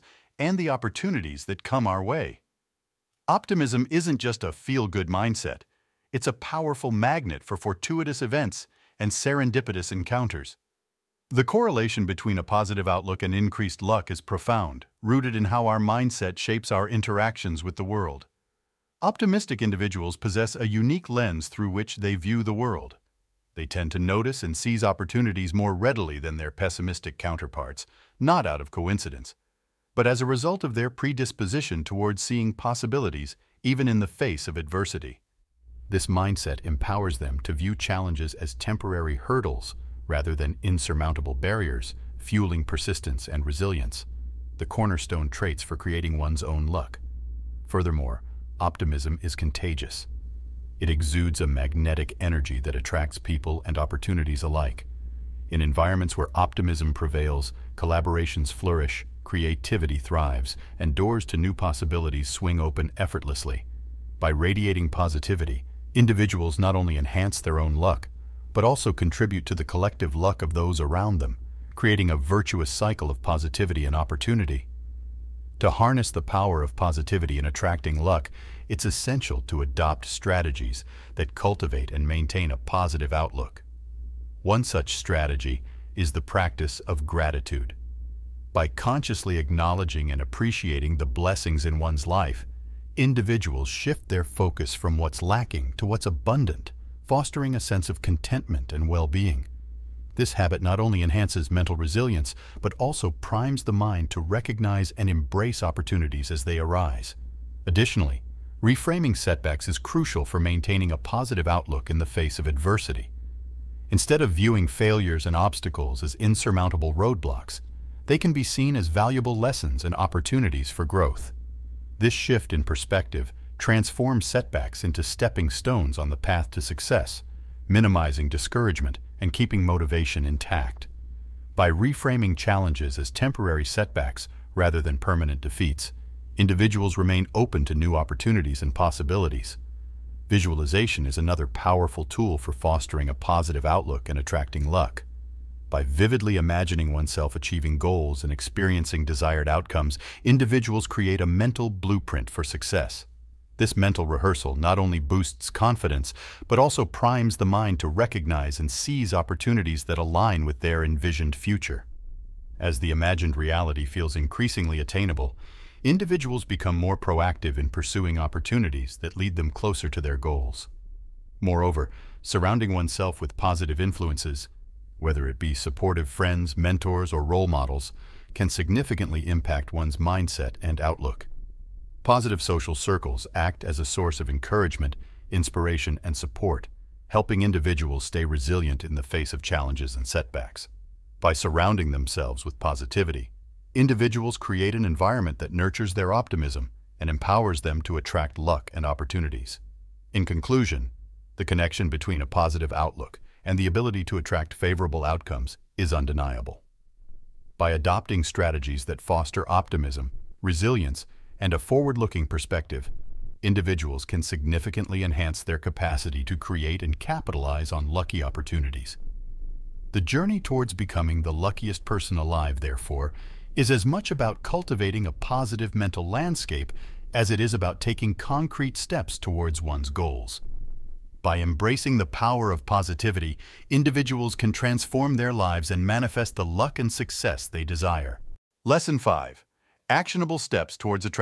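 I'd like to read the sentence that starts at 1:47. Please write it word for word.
Additionally, reframing setbacks is crucial for maintaining a positive outlook in the face of adversity.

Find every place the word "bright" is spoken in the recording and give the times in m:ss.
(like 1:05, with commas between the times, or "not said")
not said.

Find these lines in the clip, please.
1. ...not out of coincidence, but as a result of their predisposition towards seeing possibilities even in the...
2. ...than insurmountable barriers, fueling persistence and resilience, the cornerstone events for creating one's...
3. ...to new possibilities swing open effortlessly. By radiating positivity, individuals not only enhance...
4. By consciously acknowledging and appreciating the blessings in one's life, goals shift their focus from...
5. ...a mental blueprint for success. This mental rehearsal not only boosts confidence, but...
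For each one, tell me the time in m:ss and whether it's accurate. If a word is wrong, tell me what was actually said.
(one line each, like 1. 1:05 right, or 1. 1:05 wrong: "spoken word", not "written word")
1. 0:28 right
2. 0:40 wrong: "traits", not "events"
3. 1:01 right
4. 1:28 wrong: "individuals", not "goals"
5. 2:31 right.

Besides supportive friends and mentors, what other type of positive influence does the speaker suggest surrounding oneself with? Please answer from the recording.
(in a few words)
Role models.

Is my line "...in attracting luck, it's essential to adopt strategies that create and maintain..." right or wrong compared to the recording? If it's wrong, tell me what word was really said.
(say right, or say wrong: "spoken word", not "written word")
wrong: "cultivate", not "create".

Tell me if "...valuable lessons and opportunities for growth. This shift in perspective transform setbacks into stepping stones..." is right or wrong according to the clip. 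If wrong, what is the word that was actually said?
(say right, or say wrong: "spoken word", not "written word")
right.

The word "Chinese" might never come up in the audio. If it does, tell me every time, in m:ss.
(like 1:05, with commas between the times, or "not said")
not said.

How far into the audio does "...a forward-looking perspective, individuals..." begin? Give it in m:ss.
3:31.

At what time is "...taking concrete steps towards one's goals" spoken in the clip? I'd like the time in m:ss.
3:47.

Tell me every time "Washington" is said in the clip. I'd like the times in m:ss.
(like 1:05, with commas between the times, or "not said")
not said.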